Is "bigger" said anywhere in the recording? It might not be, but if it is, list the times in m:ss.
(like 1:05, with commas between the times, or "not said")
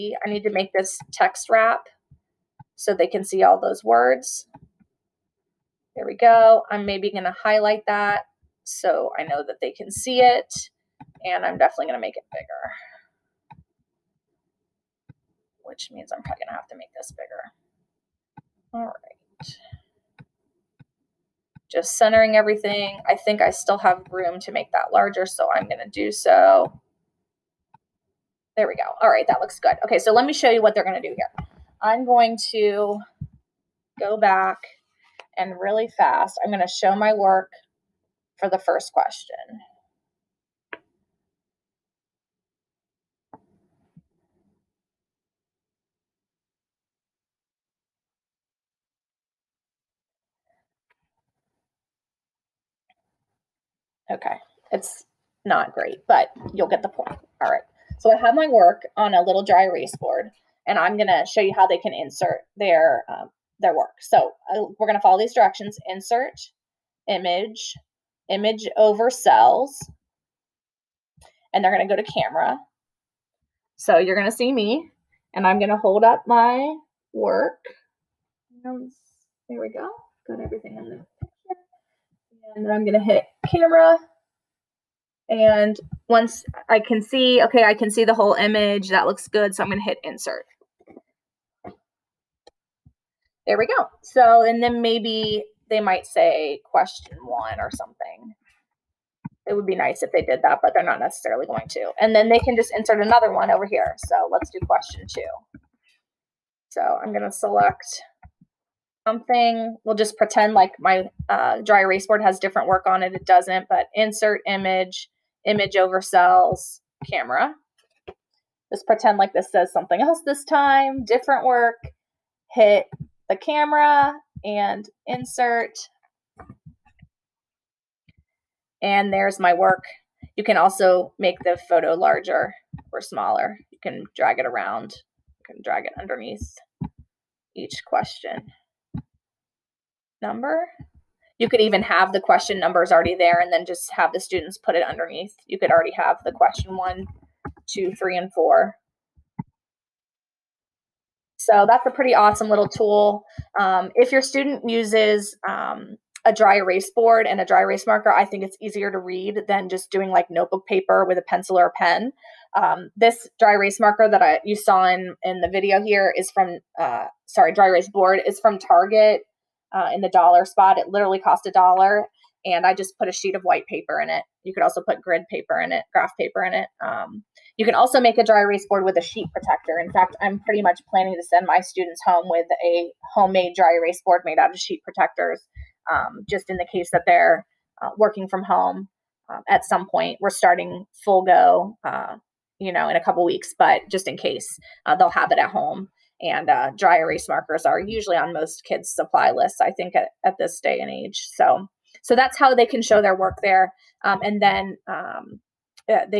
0:12, 0:17.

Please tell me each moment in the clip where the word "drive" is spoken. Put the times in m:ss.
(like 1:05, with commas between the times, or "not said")
not said.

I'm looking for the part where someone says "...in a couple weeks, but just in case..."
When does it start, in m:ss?
3:12.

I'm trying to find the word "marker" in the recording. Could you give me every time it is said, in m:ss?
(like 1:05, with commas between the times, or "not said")
2:37, 2:43, 3:17.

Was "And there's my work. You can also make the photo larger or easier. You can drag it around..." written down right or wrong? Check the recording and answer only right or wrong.
wrong.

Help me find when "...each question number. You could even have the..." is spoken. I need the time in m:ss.
2:17.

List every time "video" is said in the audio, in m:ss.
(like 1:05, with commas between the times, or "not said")
2:45.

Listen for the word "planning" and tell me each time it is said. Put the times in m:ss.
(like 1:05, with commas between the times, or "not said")
3:00.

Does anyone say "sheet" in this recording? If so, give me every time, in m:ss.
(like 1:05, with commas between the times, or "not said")
2:53, 2:59, 3:04.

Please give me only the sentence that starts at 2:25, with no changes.
You could already have the question one, two, three, and four.